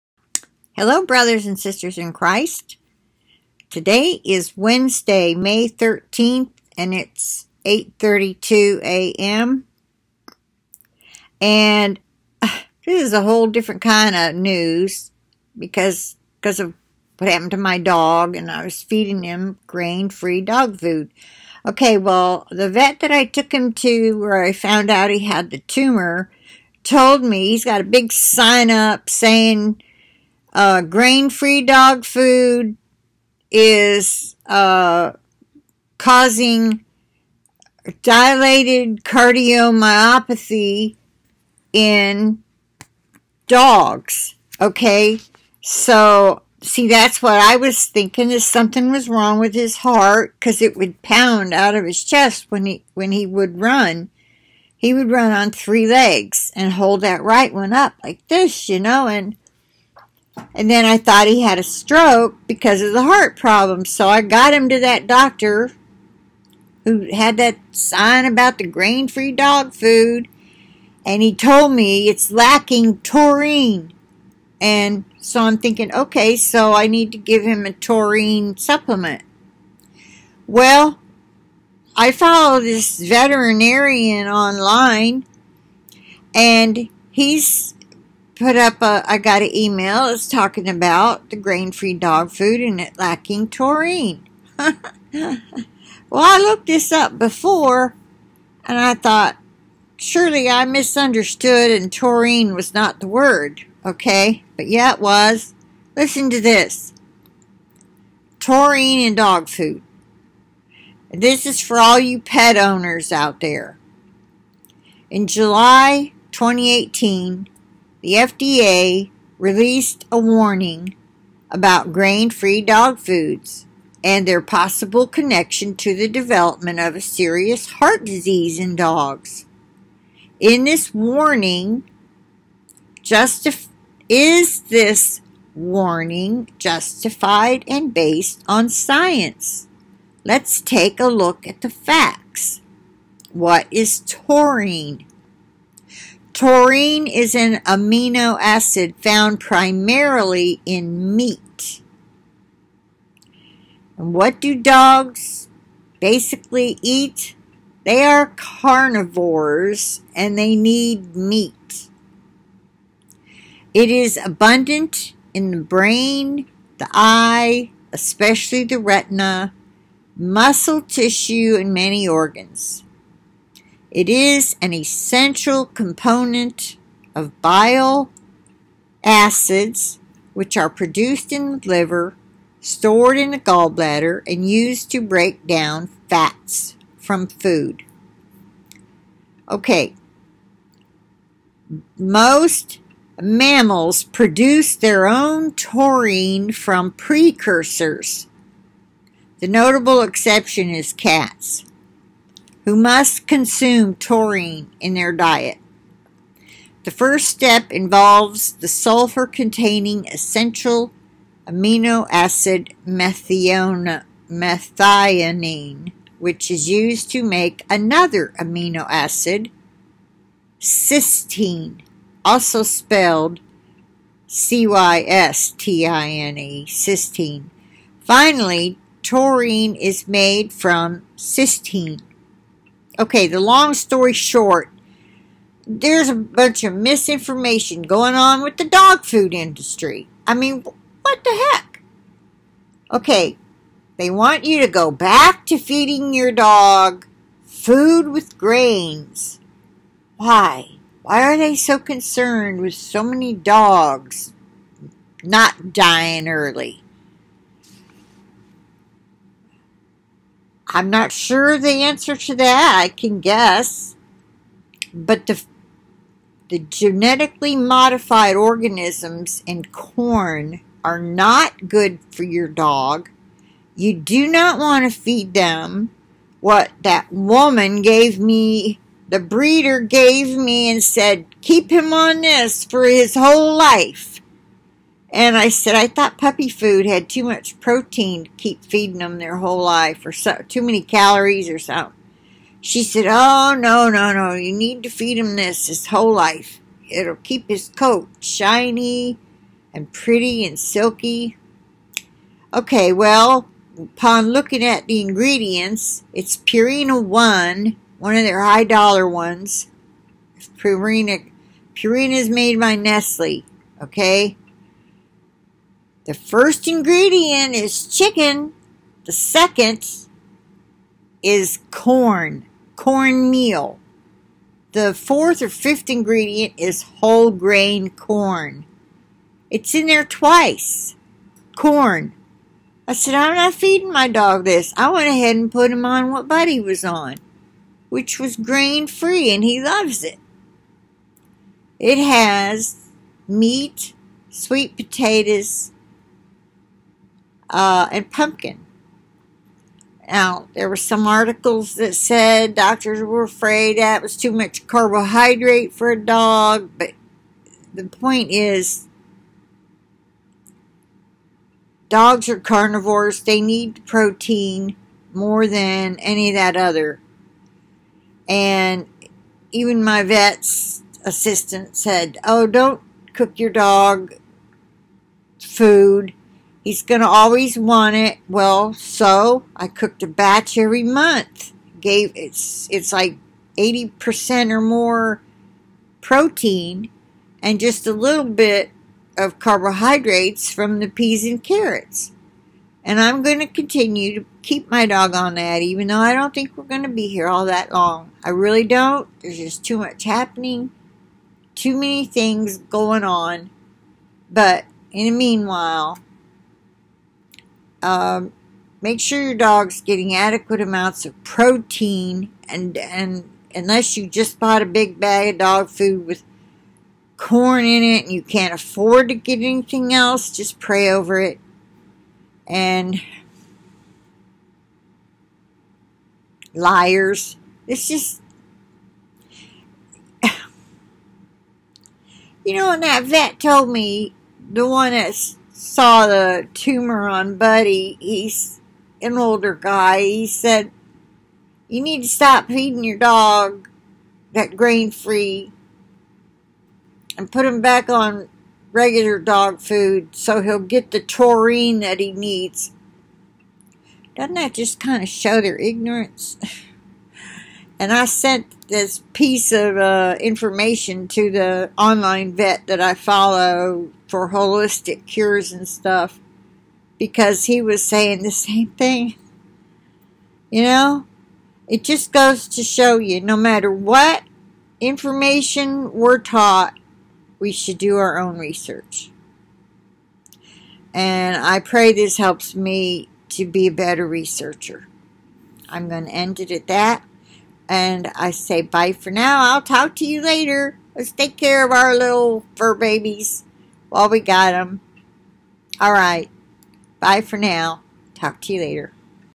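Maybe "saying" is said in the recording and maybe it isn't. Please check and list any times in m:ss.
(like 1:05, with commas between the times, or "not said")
0:29, 7:47.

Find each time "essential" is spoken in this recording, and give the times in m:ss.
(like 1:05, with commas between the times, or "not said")
2:54, 3:30.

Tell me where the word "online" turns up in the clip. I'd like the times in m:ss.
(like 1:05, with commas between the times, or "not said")
1:24, 7:41.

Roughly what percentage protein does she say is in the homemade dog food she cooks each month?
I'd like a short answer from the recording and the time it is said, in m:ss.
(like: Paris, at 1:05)
80%, at 6:23.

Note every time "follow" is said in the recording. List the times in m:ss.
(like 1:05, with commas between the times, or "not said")
1:22, 7:42.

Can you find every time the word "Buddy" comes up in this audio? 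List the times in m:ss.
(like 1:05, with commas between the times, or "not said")
5:36, 7:17.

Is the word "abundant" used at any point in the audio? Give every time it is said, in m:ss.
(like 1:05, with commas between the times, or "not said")
2:44.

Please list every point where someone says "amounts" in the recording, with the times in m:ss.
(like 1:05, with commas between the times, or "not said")
6:50.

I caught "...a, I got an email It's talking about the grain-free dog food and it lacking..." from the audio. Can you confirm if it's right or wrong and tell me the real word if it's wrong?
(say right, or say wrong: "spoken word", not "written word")
right.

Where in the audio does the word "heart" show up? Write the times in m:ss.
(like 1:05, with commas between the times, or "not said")
0:49, 1:03, 2:07.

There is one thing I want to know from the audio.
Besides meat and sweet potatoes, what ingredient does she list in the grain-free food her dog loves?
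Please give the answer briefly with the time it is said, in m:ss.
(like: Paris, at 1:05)
Pumpkin, at 5:48.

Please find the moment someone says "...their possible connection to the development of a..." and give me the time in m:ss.
2:04.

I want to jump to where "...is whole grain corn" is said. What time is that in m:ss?
5:26.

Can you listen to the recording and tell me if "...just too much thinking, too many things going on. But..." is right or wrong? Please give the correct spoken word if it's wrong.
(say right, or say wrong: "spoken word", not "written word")
wrong: "happening", not "thinking".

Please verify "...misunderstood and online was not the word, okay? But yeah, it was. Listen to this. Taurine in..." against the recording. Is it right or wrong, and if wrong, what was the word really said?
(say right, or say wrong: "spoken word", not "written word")
wrong: "taurine", not "online".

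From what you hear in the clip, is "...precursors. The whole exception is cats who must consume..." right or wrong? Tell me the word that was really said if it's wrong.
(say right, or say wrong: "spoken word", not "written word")
wrong: "notable", not "whole".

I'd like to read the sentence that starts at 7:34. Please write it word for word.
Doesn't that just kind of show their ignorance?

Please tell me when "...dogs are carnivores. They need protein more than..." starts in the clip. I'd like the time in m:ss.
6:01.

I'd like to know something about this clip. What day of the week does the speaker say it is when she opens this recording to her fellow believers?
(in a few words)
Wednesday.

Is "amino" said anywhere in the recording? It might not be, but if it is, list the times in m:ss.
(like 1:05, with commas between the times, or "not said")
2:27, 3:31, 3:38.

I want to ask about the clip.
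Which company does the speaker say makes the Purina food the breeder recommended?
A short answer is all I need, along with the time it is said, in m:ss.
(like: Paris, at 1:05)
Nestle, at 5:12.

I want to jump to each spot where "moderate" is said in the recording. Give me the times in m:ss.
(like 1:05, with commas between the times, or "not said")
not said.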